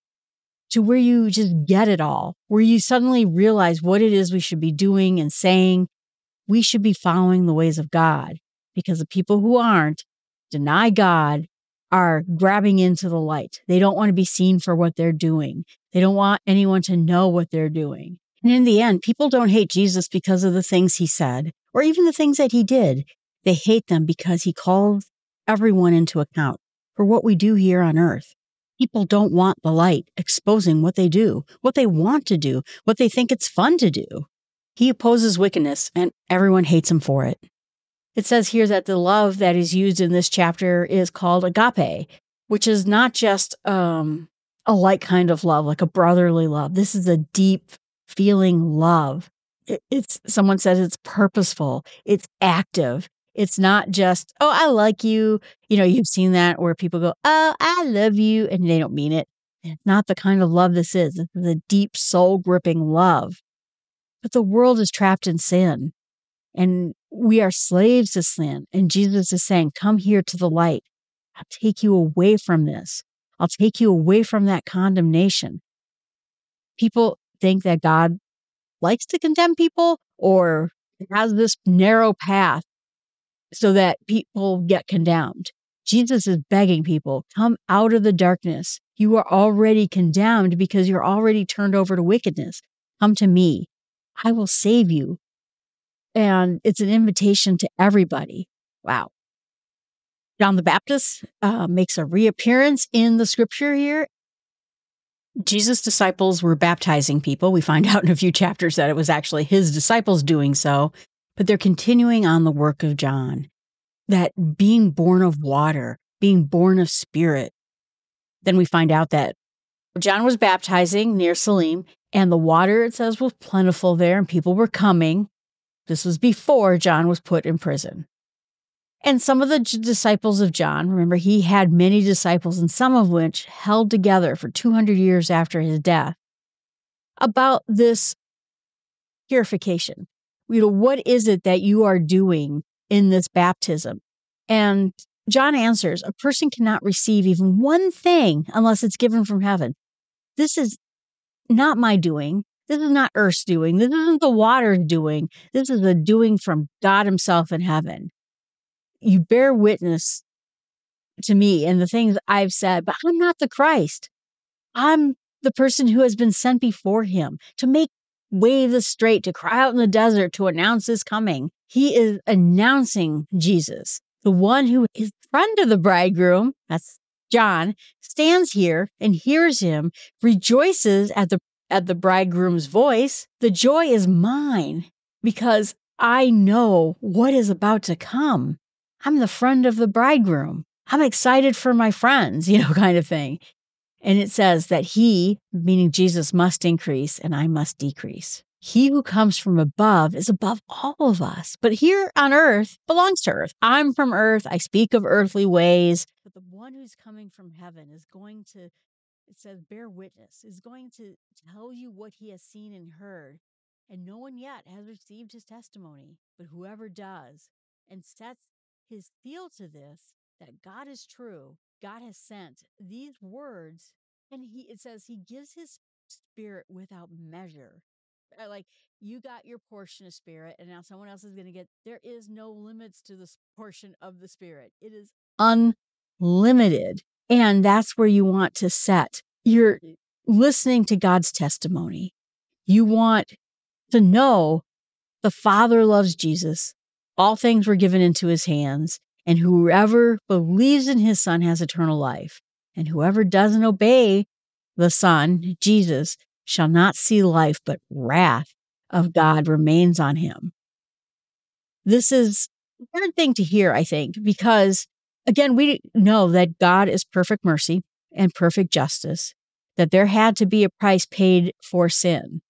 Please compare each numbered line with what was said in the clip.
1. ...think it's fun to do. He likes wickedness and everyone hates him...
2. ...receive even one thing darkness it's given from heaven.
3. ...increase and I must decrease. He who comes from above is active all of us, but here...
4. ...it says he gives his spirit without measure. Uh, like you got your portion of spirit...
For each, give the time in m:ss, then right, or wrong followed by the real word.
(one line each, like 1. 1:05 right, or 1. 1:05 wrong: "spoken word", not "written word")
1. 0:33 wrong: "opposes", not "likes"
2. 2:26 wrong: "unless", not "darkness"
3. 3:16 wrong: "above", not "active"
4. 3:44 right.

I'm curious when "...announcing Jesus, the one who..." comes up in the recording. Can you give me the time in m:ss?
2:52.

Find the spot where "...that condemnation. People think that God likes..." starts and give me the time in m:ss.
1:14.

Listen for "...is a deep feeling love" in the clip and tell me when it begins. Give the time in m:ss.
0:46.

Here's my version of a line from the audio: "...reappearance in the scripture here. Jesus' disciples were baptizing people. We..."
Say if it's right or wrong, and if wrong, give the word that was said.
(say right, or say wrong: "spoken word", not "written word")
right.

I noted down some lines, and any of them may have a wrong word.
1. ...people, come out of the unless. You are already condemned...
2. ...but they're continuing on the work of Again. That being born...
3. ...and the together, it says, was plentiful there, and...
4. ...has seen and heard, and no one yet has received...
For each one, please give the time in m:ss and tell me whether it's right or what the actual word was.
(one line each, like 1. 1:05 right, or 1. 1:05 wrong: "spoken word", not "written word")
1. 1:26 wrong: "darkness", not "unless"
2. 1:51 wrong: "John", not "Again"
3. 2:02 wrong: "water", not "together"
4. 3:32 right.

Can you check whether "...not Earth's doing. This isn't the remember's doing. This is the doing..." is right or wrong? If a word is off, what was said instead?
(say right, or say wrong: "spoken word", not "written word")
wrong: "water", not "remember".